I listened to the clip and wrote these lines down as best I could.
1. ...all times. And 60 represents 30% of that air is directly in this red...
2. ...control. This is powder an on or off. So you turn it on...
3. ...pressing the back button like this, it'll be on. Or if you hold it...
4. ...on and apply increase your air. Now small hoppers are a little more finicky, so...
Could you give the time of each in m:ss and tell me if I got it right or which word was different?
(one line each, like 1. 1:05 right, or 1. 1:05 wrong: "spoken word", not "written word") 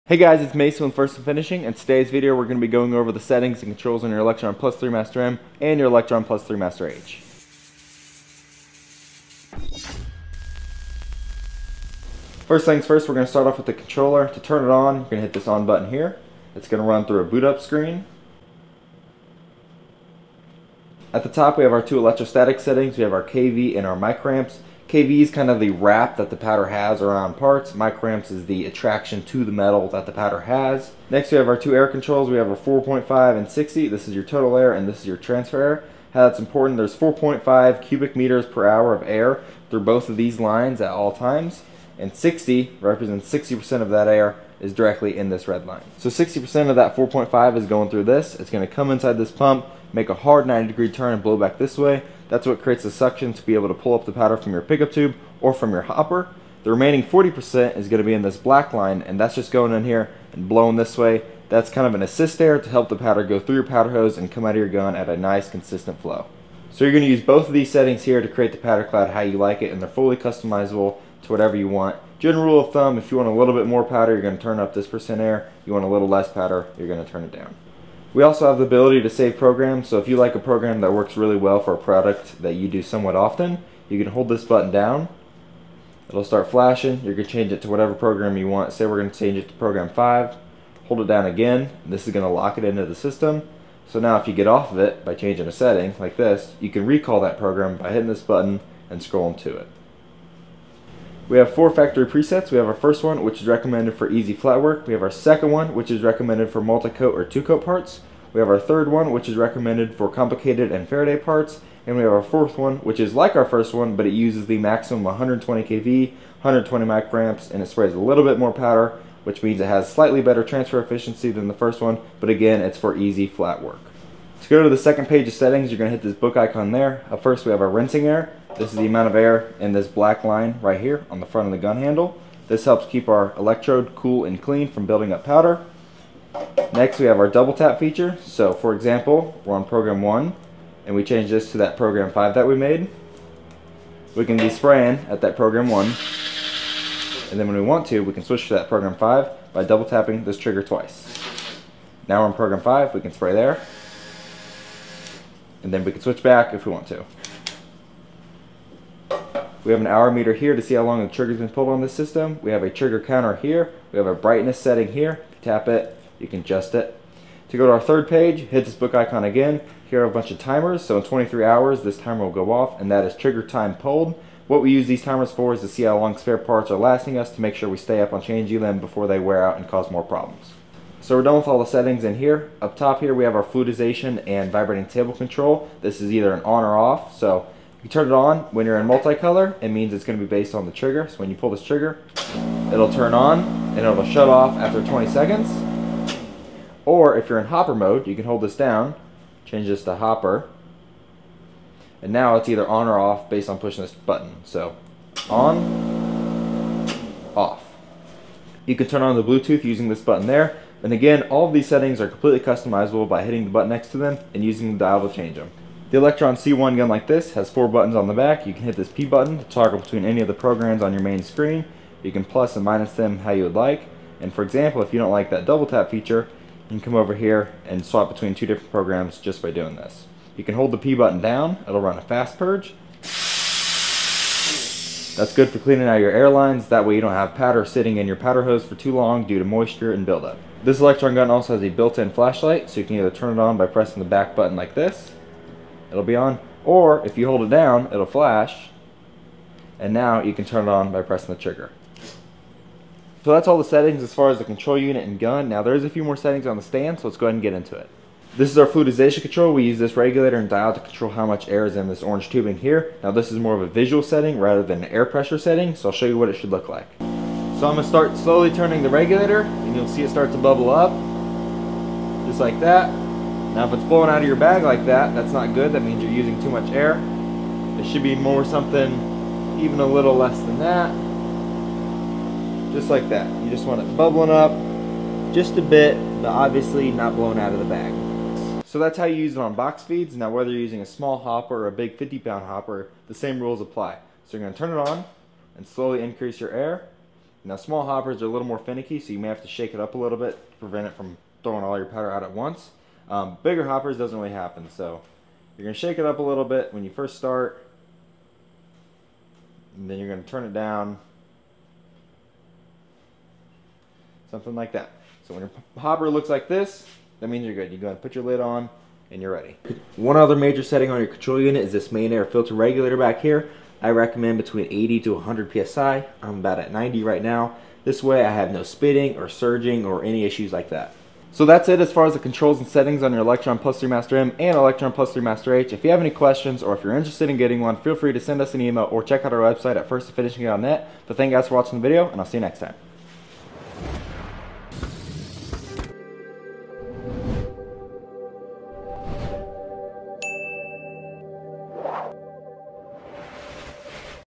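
1. 0:40 wrong: "60", not "30"
2. 3:05 wrong: "either", not "powder"
3. 4:03 right
4. 4:54 wrong: "slowly", not "apply".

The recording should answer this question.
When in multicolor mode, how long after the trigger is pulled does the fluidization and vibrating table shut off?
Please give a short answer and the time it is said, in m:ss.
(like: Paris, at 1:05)
20 seconds, at 3:14.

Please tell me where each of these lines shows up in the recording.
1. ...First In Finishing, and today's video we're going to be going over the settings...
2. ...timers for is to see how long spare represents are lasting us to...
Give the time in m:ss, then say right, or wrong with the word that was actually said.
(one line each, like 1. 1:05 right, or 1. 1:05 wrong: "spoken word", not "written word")
1. 0:00 right
2. 2:55 wrong: "parts", not "represents".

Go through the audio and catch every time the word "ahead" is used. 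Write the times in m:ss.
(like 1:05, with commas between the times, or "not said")
4:17, 5:17.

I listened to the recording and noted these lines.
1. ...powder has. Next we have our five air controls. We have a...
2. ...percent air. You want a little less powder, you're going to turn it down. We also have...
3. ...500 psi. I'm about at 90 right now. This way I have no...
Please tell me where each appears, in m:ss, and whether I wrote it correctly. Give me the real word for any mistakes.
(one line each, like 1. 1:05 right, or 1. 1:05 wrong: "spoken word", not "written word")
1. 0:30 wrong: "two", not "five"
2. 1:14 right
3. 5:25 wrong: "100", not "500".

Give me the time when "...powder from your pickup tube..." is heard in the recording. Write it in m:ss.
0:54.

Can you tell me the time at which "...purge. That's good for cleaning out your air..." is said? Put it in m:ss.
3:52.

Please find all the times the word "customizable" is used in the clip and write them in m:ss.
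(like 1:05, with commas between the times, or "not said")
1:10, 3:32.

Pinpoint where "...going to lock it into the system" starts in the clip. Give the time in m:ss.
1:32.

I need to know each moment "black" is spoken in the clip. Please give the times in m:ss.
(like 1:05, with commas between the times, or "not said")
0:58, 2:09.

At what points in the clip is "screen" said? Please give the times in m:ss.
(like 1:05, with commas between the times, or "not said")
0:17, 3:41.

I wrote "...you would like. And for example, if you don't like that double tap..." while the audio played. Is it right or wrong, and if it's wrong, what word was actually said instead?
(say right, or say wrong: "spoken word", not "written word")
right.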